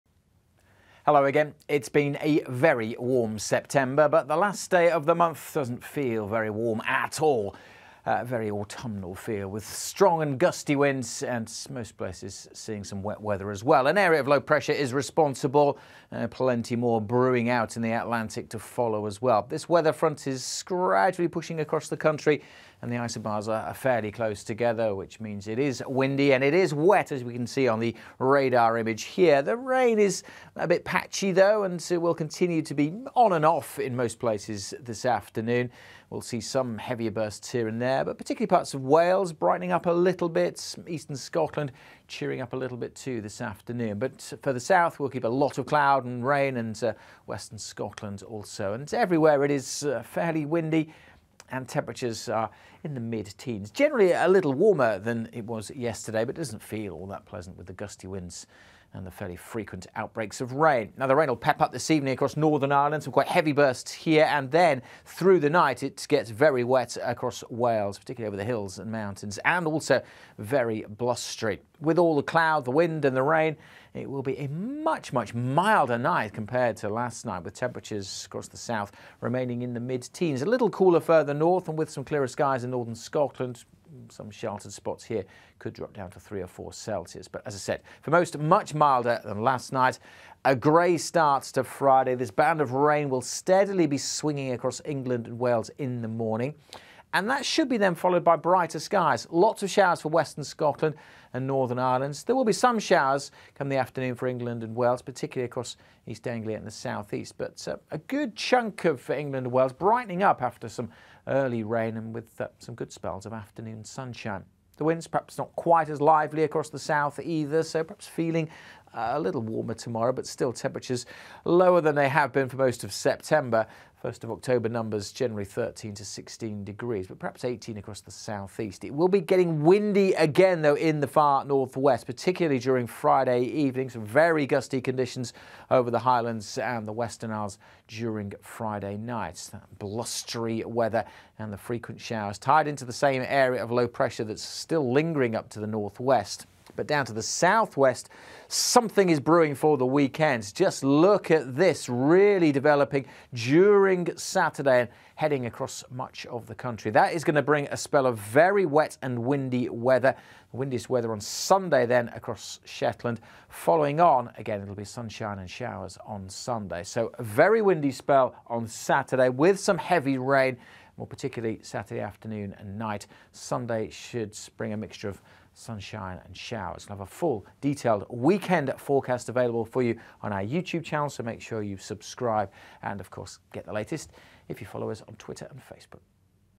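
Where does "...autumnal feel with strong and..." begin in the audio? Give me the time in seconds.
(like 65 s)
8 s.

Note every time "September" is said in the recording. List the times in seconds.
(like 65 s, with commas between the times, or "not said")
3 s, 122 s.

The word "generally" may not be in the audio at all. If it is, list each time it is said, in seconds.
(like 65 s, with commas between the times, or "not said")
53 s, 125 s.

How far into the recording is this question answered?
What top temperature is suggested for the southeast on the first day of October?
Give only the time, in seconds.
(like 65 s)
127 s.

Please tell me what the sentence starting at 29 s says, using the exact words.
The rain is a bit patchy, though, and it will continue to be on and off in most places this afternoon.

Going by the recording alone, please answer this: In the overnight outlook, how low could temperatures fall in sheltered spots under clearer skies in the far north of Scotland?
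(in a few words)
3 or 4 Celsius.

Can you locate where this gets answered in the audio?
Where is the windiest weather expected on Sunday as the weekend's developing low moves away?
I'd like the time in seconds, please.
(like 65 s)
162 s.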